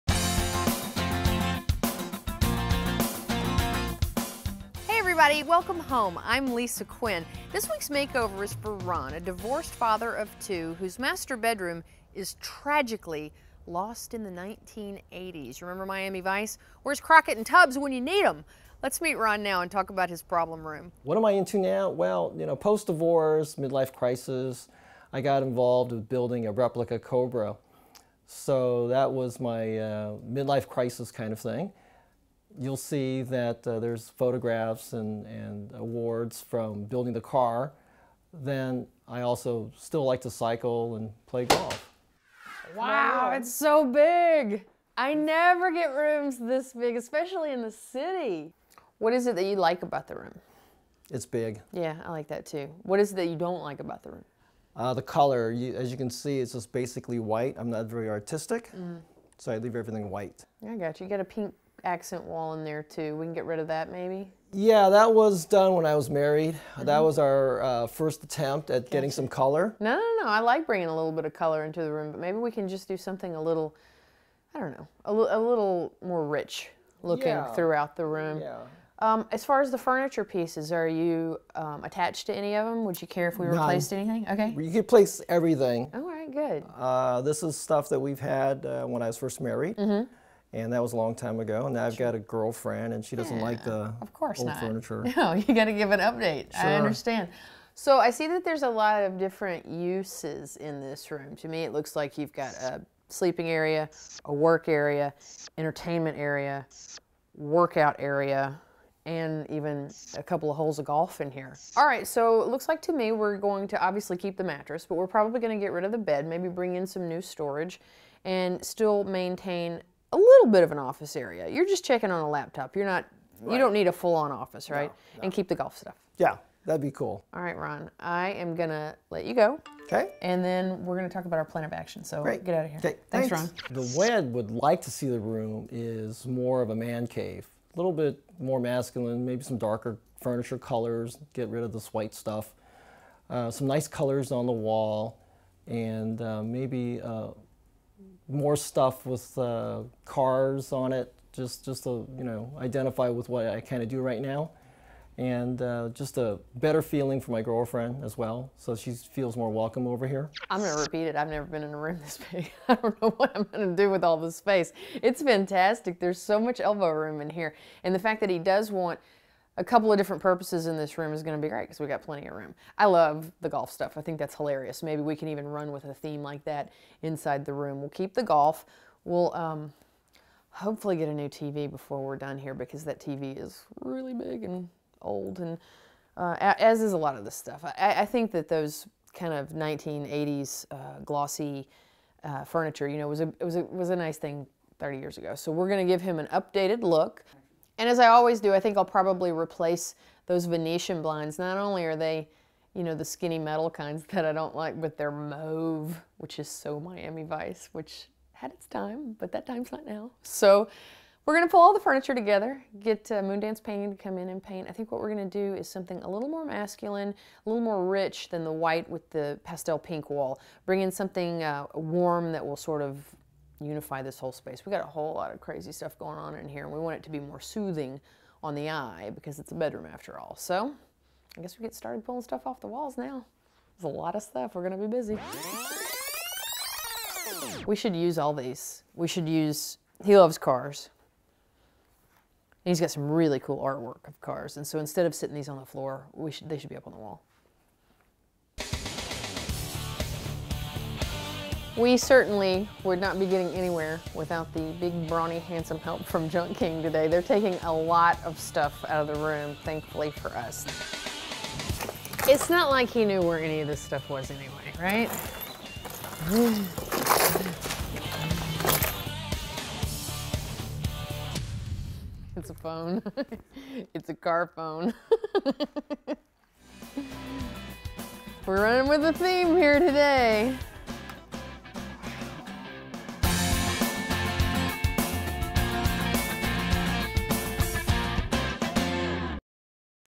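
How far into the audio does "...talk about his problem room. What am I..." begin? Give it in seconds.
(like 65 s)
19 s.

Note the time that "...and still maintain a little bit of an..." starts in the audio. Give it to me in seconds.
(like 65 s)
118 s.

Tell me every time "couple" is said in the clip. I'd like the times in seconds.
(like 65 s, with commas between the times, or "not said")
110 s, 169 s.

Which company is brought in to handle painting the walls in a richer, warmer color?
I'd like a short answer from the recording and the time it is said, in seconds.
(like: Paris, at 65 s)
Moondance Painting, at 213 s.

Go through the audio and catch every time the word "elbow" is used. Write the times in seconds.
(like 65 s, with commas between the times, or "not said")
166 s.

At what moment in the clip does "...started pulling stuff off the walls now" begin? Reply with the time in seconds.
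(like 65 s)
231 s.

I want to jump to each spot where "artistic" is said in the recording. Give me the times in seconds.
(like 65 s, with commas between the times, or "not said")
58 s.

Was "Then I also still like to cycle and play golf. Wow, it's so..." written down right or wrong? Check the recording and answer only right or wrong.
right.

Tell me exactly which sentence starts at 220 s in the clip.
Bring in something uh, warm that will sort of unify this whole space.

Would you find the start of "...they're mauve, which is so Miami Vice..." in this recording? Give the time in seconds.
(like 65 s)
204 s.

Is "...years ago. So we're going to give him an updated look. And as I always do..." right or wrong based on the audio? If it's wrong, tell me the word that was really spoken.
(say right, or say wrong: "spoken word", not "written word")
right.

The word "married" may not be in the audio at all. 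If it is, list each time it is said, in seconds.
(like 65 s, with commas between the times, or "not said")
66 s, 89 s.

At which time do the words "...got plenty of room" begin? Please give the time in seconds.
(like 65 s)
171 s.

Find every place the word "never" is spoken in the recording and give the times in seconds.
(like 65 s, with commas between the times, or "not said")
45 s, 161 s.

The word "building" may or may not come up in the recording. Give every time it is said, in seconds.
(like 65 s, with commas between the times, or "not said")
26 s, 36 s.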